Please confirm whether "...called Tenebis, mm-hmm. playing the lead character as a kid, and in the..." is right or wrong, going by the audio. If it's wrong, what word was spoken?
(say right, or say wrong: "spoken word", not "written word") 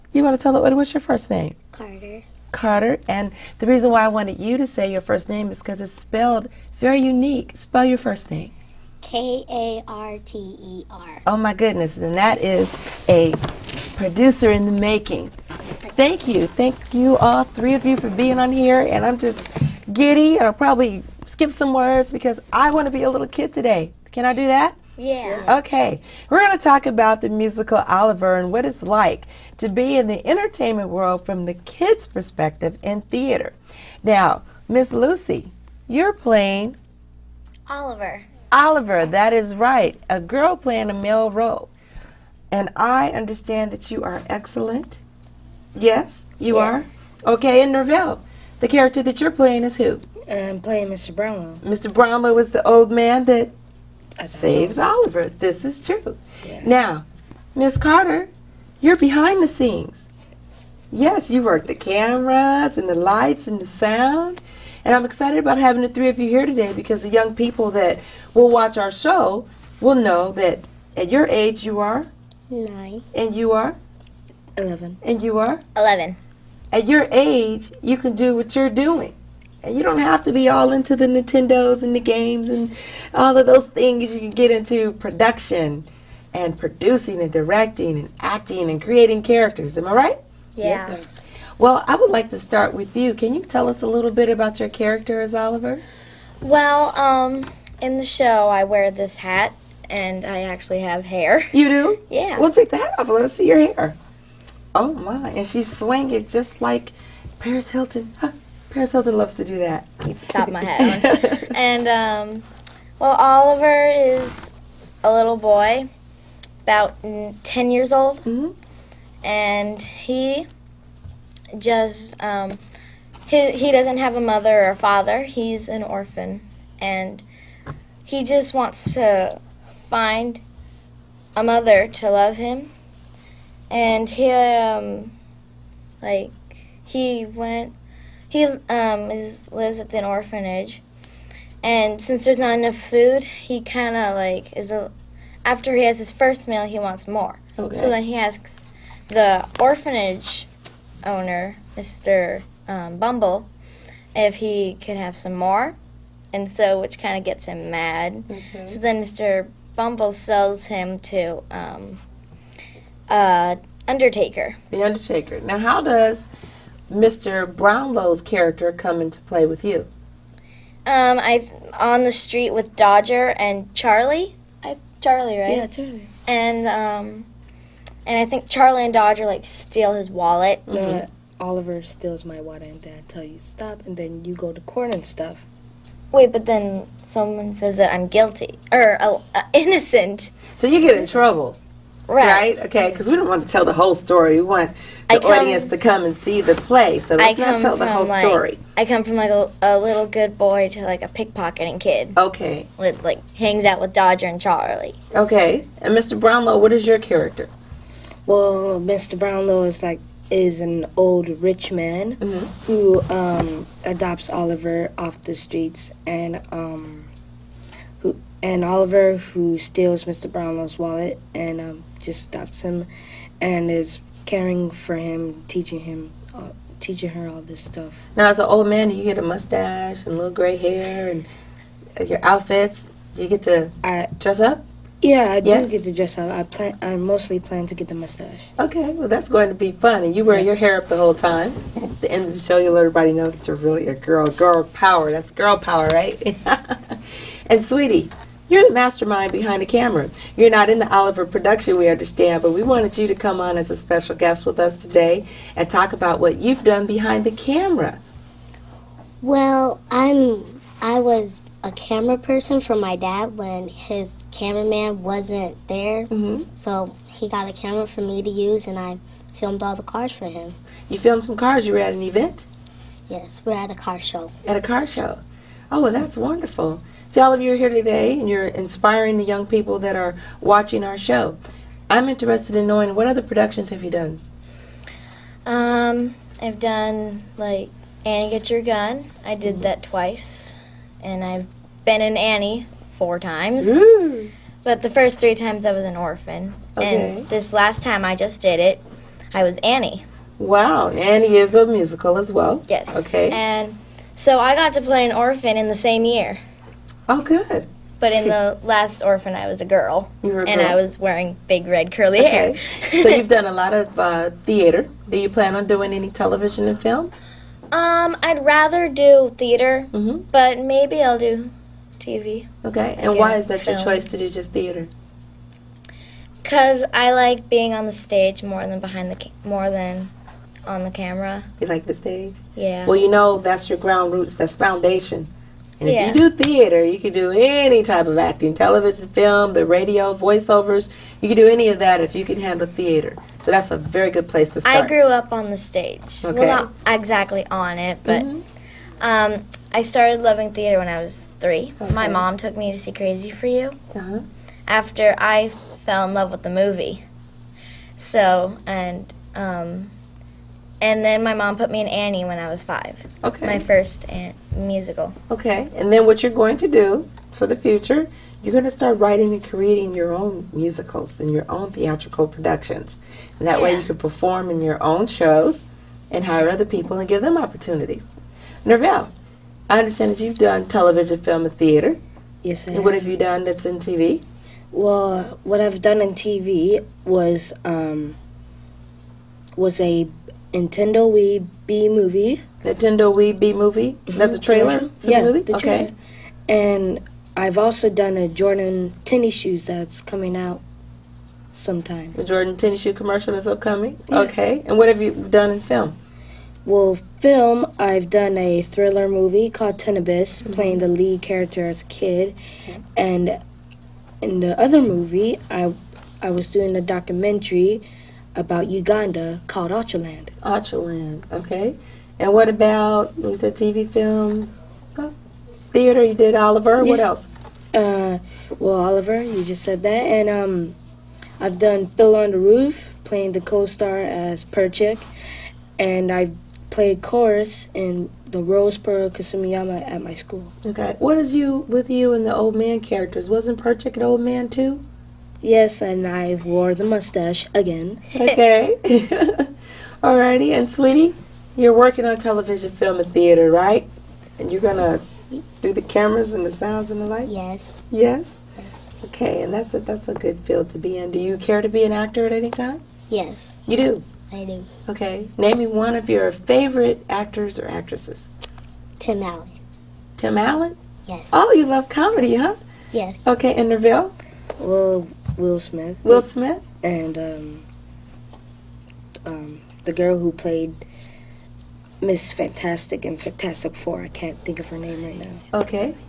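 right.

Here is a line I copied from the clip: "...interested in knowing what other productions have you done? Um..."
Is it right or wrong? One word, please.
right.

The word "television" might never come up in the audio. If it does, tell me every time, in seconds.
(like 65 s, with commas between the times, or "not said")
316 s, 338 s, 380 s, 452 s.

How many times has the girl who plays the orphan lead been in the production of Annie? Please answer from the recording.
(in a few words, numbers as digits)
4.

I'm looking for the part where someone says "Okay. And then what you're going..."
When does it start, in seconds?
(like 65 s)
365 s.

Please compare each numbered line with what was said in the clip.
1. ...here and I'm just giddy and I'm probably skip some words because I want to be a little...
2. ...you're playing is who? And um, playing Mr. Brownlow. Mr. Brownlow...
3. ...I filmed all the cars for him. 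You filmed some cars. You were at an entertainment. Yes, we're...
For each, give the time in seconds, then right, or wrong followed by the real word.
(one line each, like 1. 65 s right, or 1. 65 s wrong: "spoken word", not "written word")
1. 18 s right
2. 49 s right
3. 268 s wrong: "event", not "entertainment".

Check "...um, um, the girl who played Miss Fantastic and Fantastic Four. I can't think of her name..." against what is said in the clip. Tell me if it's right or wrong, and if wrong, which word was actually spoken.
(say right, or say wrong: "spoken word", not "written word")
right.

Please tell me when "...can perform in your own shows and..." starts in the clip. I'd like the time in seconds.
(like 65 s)
373 s.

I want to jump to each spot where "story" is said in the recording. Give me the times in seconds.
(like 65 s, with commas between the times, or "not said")
193 s, 198 s.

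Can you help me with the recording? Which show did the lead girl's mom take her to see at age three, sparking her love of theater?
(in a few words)
Crazy for You.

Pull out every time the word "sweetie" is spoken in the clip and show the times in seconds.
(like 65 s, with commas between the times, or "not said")
247 s, 450 s.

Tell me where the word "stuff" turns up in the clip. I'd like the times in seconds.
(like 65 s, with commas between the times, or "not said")
185 s, 227 s.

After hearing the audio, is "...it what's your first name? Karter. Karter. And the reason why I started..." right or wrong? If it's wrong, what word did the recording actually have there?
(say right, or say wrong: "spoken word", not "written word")
wrong: "wanted", not "started".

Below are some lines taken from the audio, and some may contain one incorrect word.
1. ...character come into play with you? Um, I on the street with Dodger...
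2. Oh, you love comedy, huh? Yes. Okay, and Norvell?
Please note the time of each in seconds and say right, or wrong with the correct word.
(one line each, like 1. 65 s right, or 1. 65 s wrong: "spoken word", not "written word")
1. 168 s right
2. 471 s right.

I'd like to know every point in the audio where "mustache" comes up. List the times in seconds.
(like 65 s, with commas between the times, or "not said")
229 s, 237 s, 446 s.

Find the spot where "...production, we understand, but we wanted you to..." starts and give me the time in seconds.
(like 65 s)
251 s.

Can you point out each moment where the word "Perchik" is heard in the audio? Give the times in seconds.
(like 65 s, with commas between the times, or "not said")
434 s, 443 s.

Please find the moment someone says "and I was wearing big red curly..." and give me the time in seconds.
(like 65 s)
310 s.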